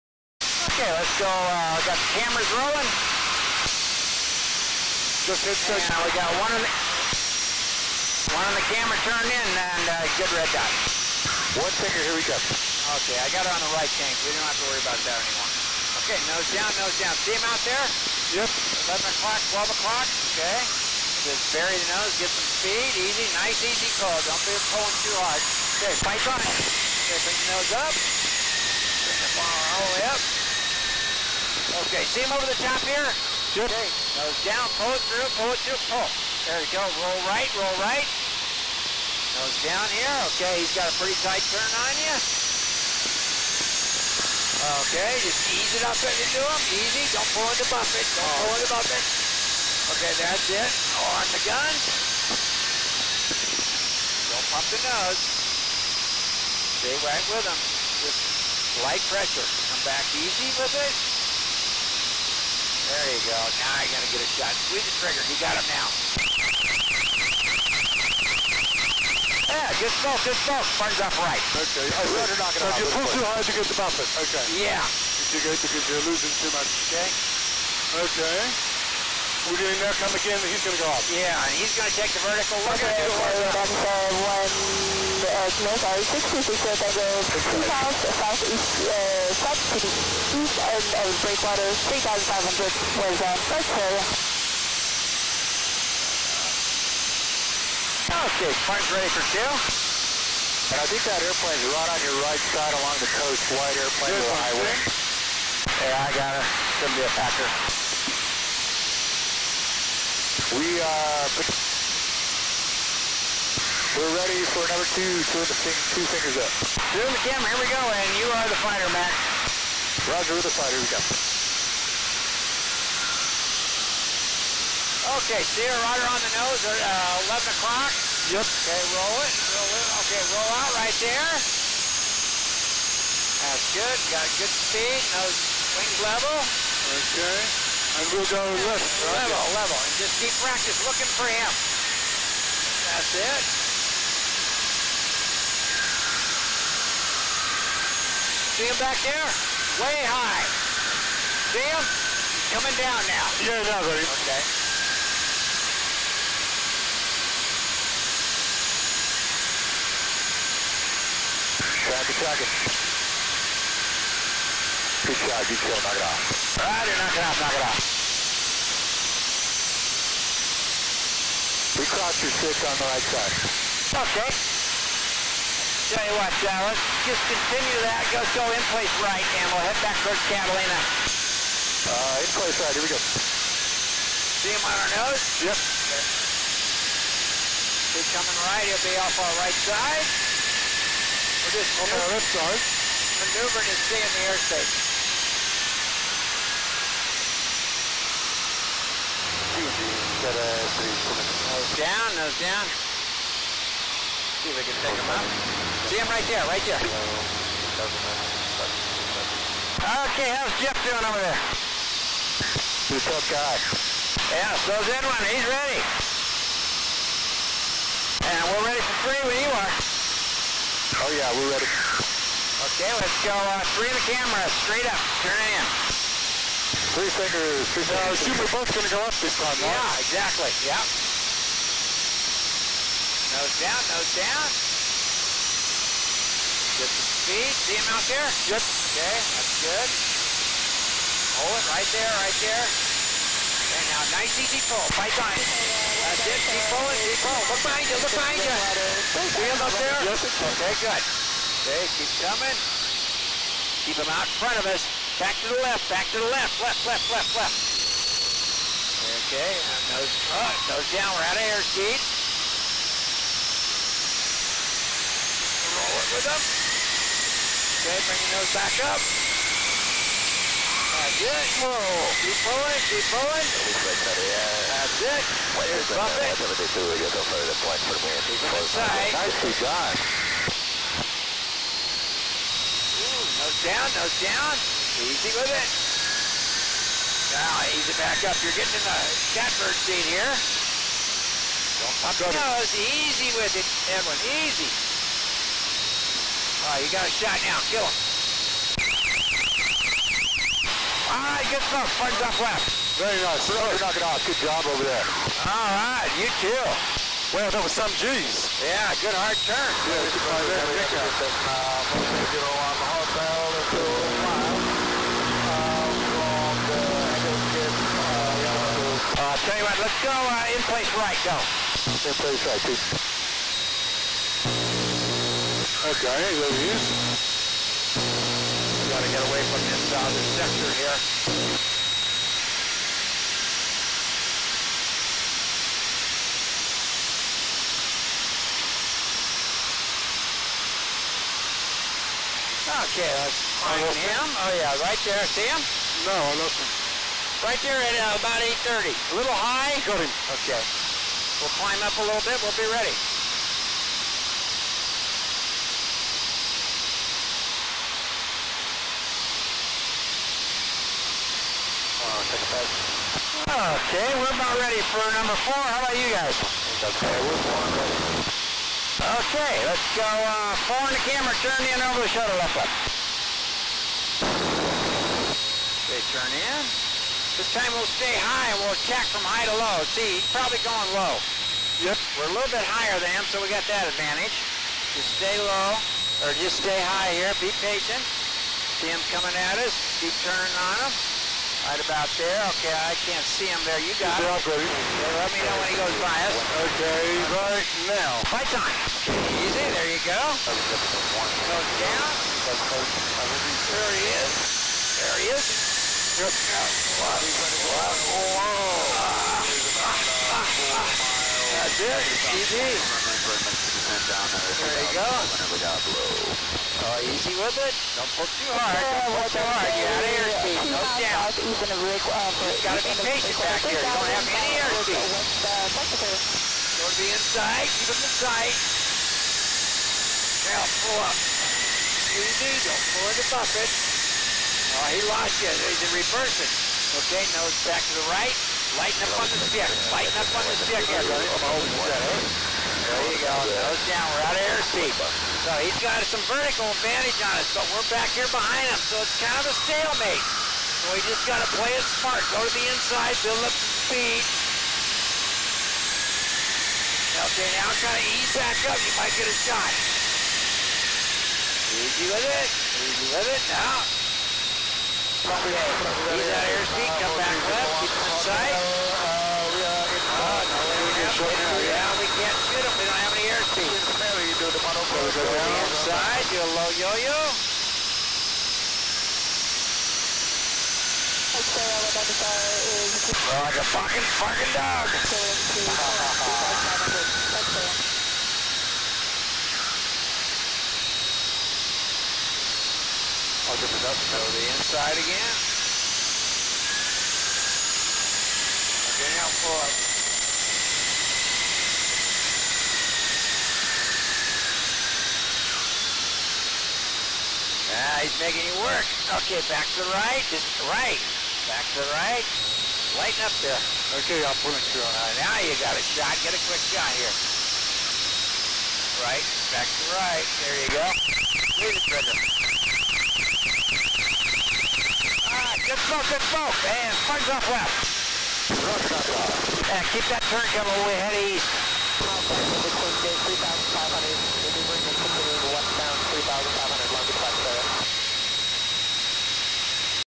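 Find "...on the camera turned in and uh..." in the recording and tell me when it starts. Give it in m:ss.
0:08.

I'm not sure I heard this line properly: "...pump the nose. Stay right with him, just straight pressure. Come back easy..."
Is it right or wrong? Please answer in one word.
wrong.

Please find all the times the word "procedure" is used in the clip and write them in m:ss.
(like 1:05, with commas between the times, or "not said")
not said.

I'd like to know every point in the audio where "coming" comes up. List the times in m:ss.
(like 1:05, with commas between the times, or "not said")
2:32, 3:08, 4:12, 6:29, 8:50.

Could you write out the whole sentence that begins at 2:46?
All right, knock it off, knock it off.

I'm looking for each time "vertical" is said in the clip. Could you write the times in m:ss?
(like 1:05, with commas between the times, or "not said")
1:22, 7:26.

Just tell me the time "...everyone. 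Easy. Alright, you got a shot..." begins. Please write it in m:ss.
4:53.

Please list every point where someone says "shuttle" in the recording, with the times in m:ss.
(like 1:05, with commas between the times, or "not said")
6:12.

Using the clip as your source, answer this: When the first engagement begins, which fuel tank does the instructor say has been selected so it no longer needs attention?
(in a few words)
right tank.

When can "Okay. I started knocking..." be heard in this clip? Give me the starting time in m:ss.
1:11.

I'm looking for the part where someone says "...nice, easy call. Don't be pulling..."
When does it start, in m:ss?
0:23.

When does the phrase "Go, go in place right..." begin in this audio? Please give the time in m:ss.
2:58.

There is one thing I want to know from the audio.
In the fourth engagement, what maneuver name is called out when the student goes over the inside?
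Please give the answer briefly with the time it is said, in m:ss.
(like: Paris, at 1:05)
low yo-yo, at 7:56.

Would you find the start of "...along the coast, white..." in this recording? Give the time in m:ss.
1:42.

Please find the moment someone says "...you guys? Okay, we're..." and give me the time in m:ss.
6:05.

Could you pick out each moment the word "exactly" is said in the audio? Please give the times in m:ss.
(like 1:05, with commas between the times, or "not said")
3:50.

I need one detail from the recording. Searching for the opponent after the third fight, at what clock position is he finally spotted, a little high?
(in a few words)
8.30.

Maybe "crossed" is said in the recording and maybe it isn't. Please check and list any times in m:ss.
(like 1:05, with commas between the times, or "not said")
2:51.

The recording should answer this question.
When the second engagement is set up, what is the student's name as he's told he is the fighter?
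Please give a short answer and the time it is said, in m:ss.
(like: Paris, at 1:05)
Matt, at 1:58.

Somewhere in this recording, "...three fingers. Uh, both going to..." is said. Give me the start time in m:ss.
3:47.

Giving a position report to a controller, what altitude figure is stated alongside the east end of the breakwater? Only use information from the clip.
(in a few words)
3,500.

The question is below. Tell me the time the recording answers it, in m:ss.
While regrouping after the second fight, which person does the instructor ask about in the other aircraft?
3:30.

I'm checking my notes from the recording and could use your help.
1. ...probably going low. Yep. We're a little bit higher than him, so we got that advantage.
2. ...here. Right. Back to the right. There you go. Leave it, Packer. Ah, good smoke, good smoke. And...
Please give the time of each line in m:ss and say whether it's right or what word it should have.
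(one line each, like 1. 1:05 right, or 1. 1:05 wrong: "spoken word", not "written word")
1. 6:20 right
2. 8:36 wrong: "Brenda", not "Packer".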